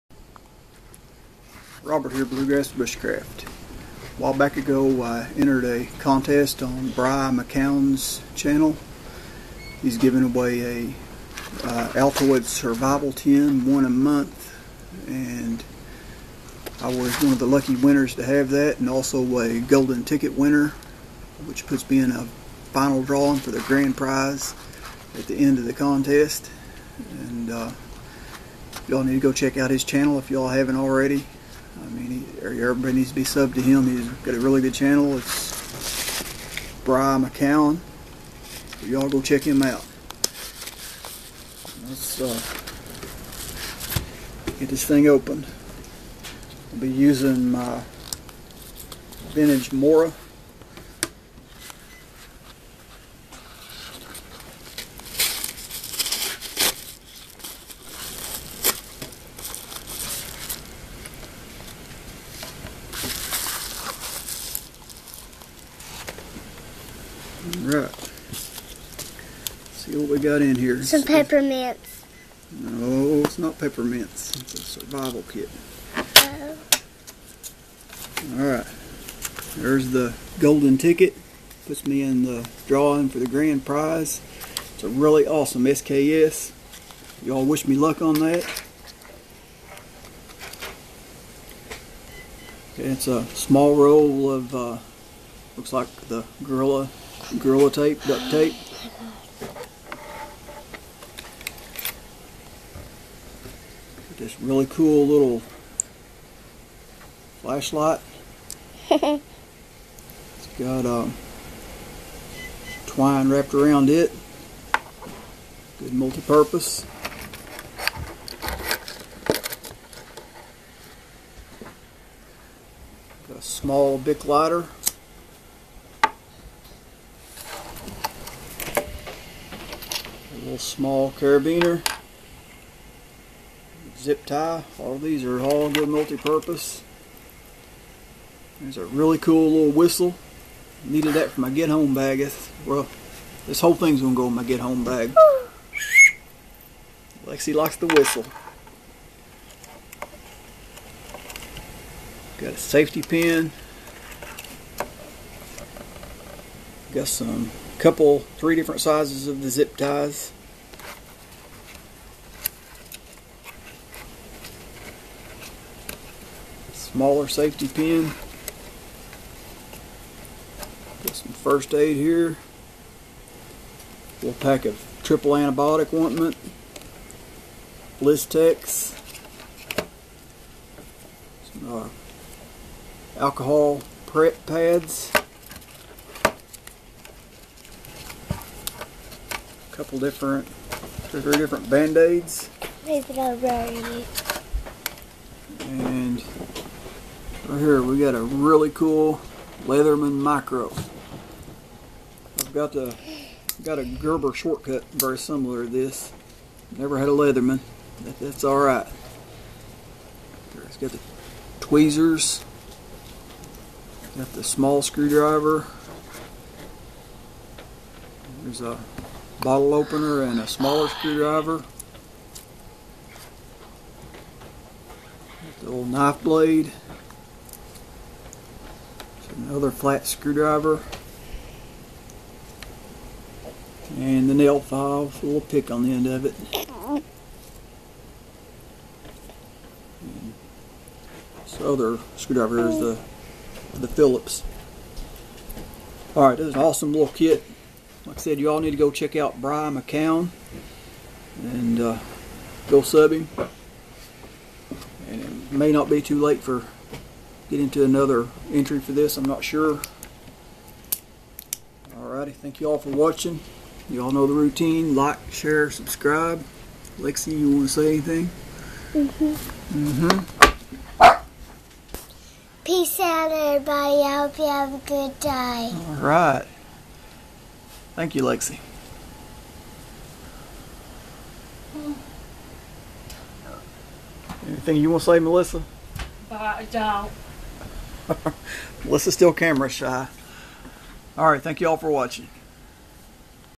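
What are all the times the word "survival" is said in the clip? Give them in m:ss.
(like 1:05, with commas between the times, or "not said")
0:12, 1:14.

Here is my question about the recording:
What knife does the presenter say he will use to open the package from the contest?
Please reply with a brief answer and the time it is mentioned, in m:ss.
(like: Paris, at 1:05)
Vintage Mora, at 0:49.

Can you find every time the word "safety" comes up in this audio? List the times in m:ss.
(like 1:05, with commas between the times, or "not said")
2:32, 2:47.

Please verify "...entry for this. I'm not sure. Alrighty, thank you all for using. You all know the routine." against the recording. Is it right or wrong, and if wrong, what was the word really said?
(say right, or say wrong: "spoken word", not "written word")
wrong: "watching", not "using".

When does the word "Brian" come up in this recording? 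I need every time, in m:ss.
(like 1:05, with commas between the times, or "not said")
0:36, 4:09.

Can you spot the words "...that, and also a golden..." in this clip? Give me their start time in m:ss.
0:18.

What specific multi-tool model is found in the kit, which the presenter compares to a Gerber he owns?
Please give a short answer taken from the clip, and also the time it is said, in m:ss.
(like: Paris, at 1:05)
Leatherman Micra, at 3:19.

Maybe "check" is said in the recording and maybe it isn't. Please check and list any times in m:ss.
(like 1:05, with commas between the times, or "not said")
0:29, 0:39, 4:08.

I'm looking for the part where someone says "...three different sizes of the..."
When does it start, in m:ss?
2:38.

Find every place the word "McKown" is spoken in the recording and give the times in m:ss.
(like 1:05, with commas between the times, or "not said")
0:07, 0:37, 4:09.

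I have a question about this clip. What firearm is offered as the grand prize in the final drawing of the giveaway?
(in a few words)
SKS.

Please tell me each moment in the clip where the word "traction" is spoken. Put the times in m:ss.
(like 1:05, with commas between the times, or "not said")
not said.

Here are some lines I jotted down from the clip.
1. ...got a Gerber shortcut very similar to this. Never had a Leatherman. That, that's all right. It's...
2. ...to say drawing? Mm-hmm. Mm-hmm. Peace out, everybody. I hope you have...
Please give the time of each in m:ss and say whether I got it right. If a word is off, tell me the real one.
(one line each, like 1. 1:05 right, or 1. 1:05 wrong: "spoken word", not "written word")
1. 3:23 right
2. 4:27 wrong: "anything", not "drawing".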